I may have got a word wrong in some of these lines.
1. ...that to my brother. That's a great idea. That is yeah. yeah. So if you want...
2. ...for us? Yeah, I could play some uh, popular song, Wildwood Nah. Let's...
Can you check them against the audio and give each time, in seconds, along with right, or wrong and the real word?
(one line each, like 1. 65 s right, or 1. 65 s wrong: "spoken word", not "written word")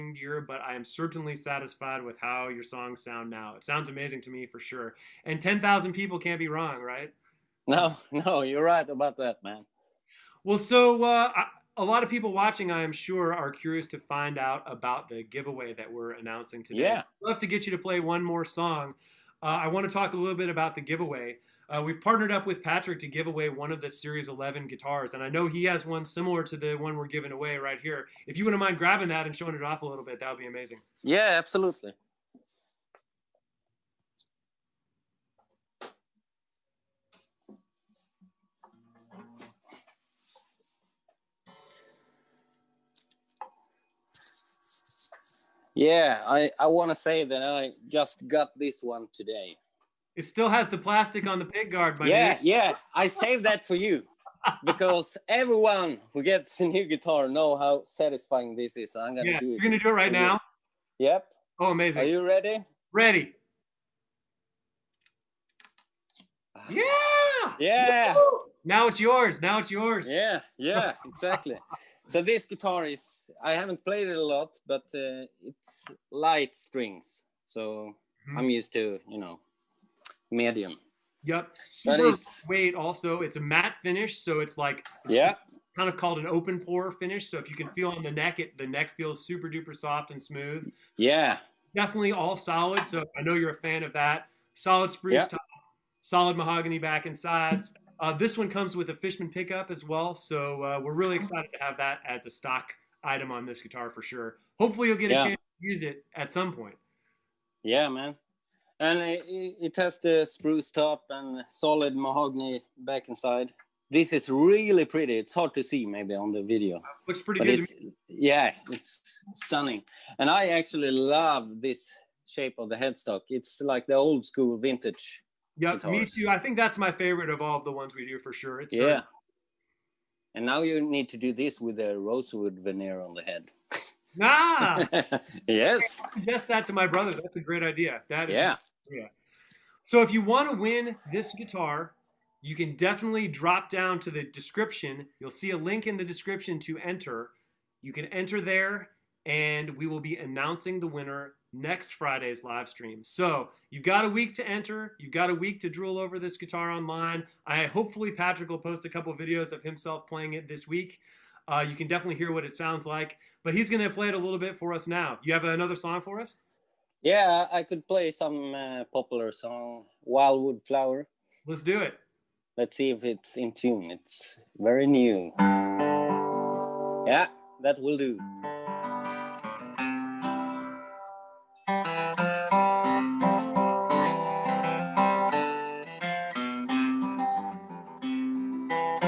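1. 136 s right
2. 166 s wrong: "Flower", not "Nah".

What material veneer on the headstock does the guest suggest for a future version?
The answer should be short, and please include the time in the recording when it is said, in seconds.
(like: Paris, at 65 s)
rosewood, at 131 s.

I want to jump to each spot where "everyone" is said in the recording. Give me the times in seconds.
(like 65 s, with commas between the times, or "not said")
55 s.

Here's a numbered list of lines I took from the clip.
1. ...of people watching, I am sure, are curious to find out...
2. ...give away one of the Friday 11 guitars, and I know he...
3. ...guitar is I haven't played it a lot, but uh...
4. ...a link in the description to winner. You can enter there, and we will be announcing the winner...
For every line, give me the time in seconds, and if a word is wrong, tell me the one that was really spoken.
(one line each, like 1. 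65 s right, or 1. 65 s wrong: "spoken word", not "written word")
1. 12 s right
2. 23 s wrong: "Series", not "Friday"
3. 72 s right
4. 145 s wrong: "enter", not "winner".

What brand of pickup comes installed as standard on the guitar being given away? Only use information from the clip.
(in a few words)
Fishman.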